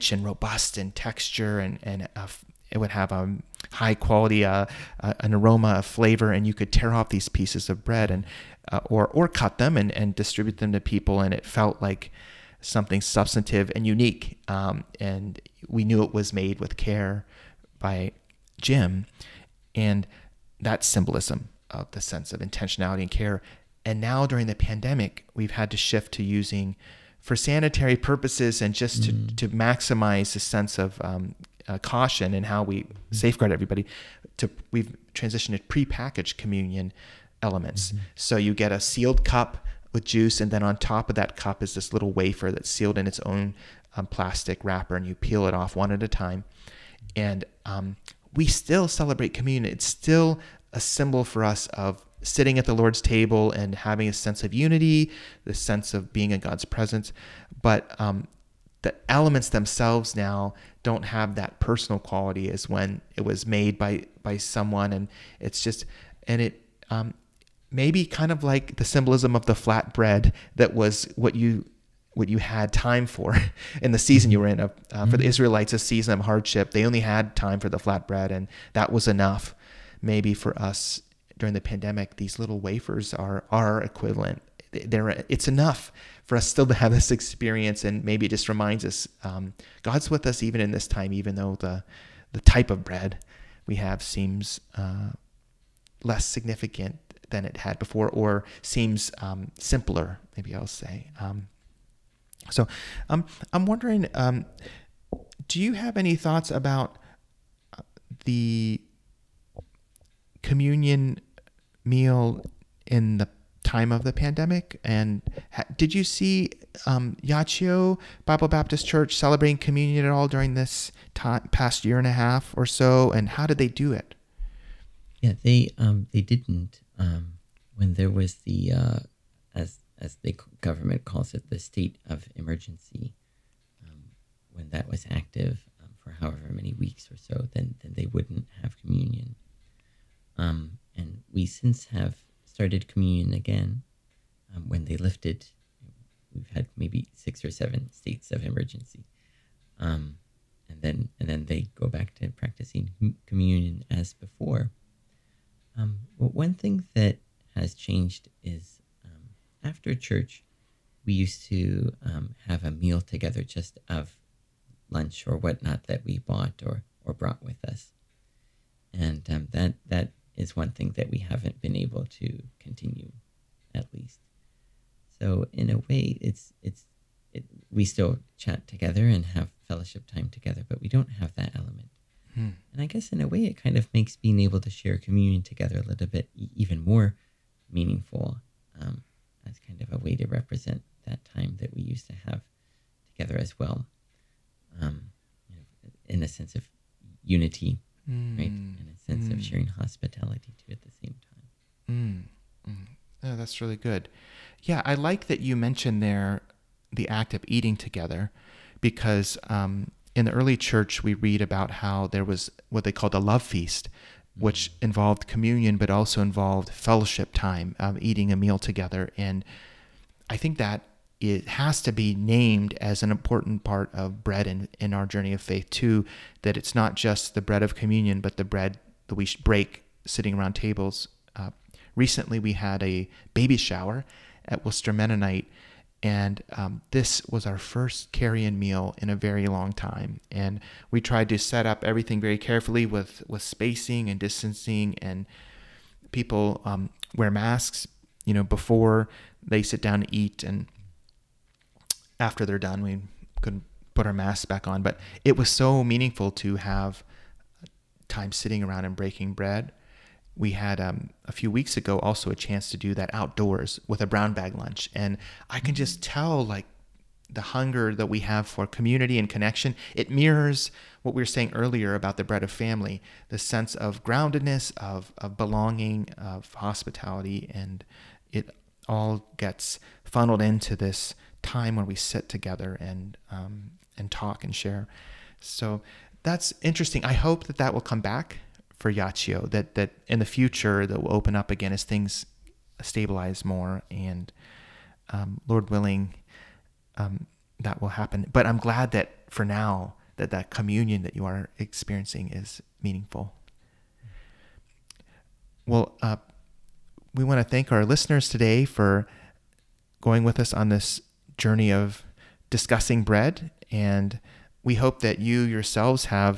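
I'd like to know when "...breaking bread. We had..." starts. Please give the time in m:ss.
4:18.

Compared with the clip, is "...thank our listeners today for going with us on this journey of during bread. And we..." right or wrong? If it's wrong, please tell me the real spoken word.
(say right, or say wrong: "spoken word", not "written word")
wrong: "discussing", not "during".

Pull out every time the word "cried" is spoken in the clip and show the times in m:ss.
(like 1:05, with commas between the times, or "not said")
not said.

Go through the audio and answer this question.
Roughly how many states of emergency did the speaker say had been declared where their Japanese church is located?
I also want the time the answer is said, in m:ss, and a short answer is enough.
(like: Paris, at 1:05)
6 or 7, at 2:27.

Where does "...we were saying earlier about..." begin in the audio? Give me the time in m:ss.
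4:31.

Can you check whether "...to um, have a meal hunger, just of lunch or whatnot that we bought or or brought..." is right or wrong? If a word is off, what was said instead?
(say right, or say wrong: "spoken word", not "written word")
wrong: "together", not "hunger".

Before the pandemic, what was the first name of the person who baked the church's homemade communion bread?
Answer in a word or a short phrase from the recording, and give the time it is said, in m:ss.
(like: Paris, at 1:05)
Jim, at 0:18.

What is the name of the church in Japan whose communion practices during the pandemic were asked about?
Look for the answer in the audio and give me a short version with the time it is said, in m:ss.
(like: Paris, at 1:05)
Yachio Bible Baptist Church, at 1:57.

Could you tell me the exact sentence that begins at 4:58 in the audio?
But I'm glad that for now that that communion that you are experiencing is meaningful.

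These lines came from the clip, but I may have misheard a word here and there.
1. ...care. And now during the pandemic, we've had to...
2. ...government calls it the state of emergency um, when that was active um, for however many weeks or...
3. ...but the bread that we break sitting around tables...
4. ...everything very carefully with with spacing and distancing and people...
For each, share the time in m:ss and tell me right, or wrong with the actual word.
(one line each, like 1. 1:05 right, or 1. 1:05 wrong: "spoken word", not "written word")
1. 0:23 right
2. 2:10 right
3. 3:48 right
4. 4:01 right.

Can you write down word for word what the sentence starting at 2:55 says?
So in a way, it's it's it, we still chat together and have fellowship time together, but we don't have that element.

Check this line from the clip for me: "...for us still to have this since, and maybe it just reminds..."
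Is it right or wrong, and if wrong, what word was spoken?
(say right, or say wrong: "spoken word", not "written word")
wrong: "experience", not "since".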